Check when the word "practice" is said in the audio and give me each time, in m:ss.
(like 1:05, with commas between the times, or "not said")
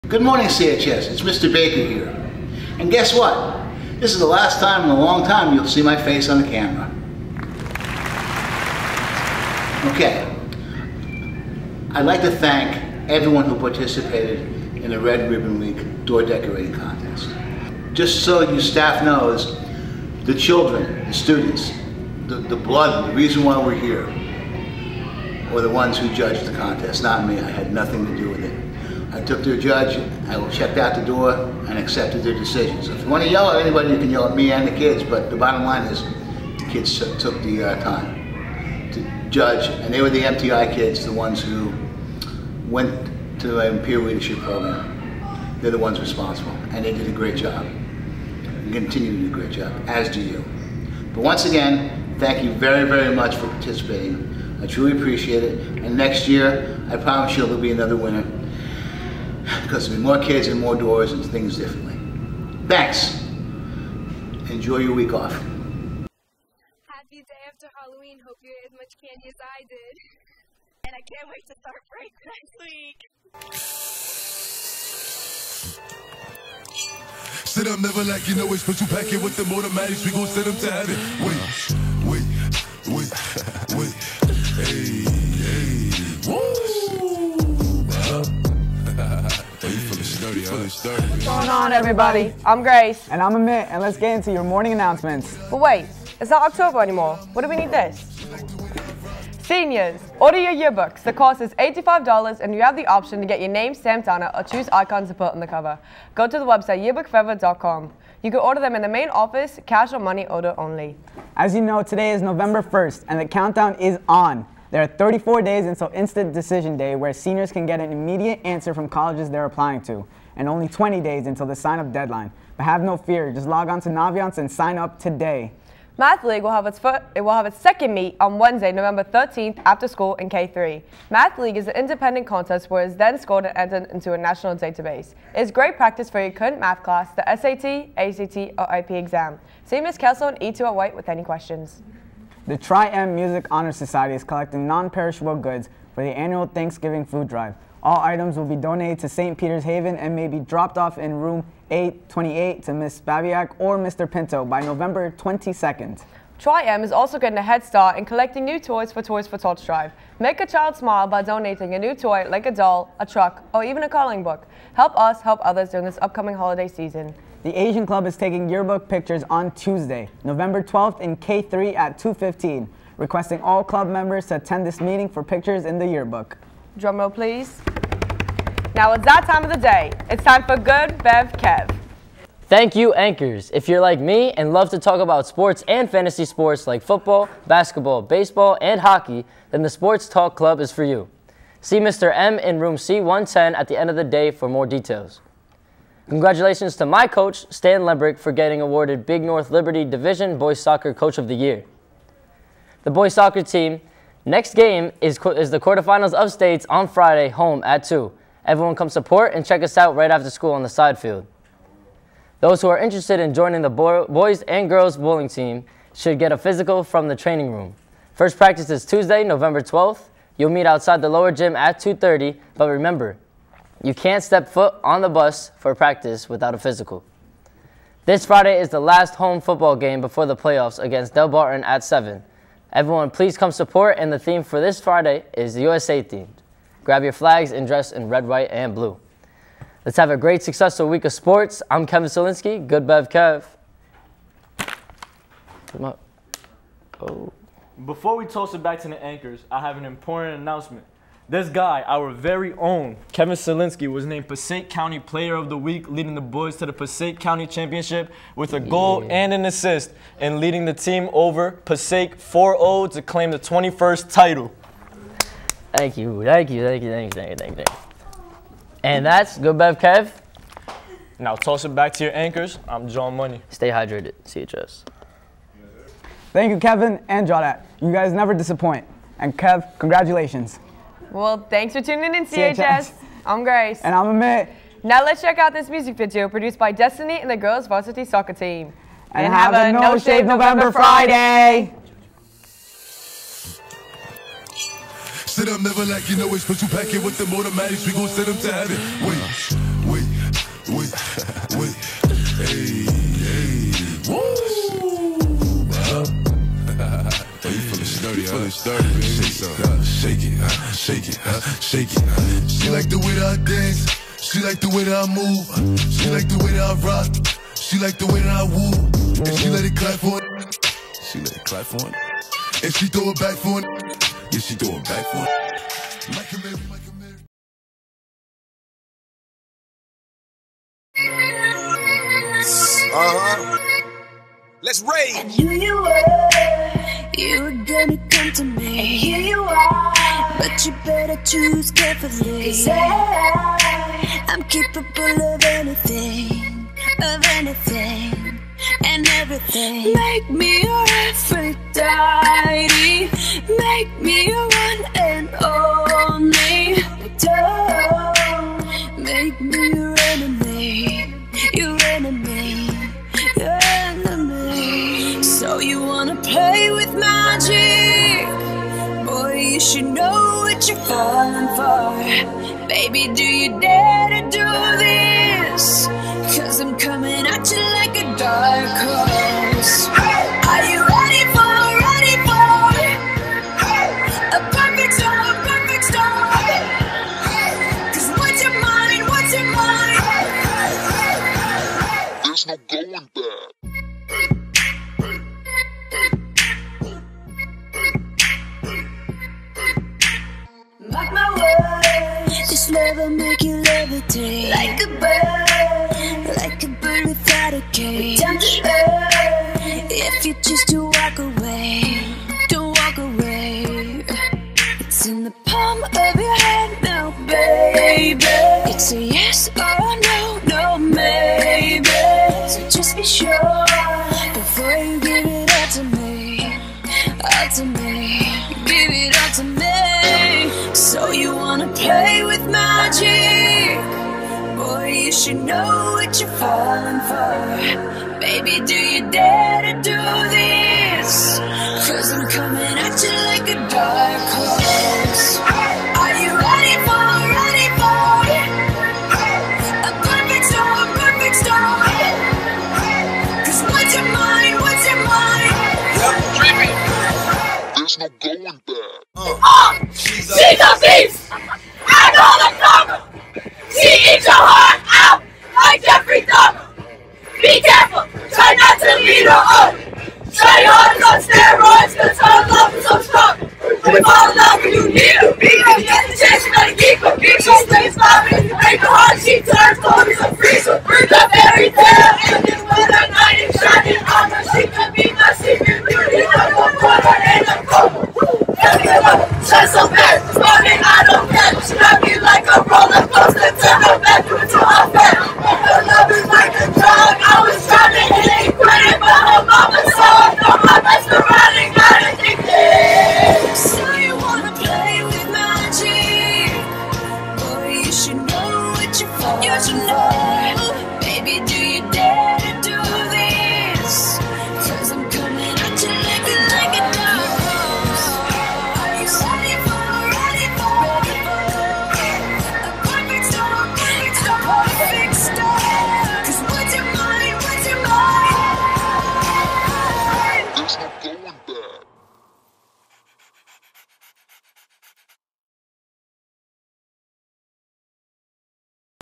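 2:15, 3:38, 3:45.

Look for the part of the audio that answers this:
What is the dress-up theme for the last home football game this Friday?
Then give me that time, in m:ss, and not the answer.
3:55.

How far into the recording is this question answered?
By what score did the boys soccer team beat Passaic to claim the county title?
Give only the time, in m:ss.
4:22.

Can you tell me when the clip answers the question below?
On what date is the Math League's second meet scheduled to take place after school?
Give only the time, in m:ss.
2:08.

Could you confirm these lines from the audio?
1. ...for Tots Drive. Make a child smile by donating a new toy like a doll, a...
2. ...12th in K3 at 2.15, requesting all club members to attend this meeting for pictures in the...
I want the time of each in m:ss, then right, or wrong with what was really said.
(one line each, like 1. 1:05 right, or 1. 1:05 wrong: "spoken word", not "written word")
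1. 2:39 right
2. 2:50 right.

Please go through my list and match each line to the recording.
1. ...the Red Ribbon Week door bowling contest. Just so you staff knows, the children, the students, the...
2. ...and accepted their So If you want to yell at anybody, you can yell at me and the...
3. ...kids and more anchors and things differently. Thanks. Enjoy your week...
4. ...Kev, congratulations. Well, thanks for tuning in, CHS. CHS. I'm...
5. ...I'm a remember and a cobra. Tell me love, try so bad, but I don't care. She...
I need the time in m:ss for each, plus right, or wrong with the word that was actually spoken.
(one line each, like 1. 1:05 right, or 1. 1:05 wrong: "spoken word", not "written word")
1. 0:14 wrong: "decorating", not "bowling"
2. 0:31 right
3. 1:00 wrong: "doors", not "anchors"
4. 4:39 right
5. 8:06 wrong: "quarter", not "remember".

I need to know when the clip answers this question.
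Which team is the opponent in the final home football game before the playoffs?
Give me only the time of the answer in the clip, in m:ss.
3:51.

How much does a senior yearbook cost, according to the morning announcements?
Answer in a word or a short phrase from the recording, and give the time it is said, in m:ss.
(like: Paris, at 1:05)
$85, at 1:41.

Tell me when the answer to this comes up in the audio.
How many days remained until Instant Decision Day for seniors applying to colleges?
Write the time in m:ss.
1:54.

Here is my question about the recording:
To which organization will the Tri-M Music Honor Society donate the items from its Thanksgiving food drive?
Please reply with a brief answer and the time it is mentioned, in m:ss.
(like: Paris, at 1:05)
St. Peter's Haven, at 2:29.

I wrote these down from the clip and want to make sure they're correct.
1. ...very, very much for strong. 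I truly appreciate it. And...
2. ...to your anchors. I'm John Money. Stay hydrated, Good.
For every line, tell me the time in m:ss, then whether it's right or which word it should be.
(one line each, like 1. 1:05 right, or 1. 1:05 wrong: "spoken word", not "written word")
1. 0:52 wrong: "participating", not "strong"
2. 4:31 wrong: "CHS", not "Good".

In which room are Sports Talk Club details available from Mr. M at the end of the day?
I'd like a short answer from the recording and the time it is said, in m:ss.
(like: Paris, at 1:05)
C110, at 3:12.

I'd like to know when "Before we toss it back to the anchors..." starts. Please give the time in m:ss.
4:07.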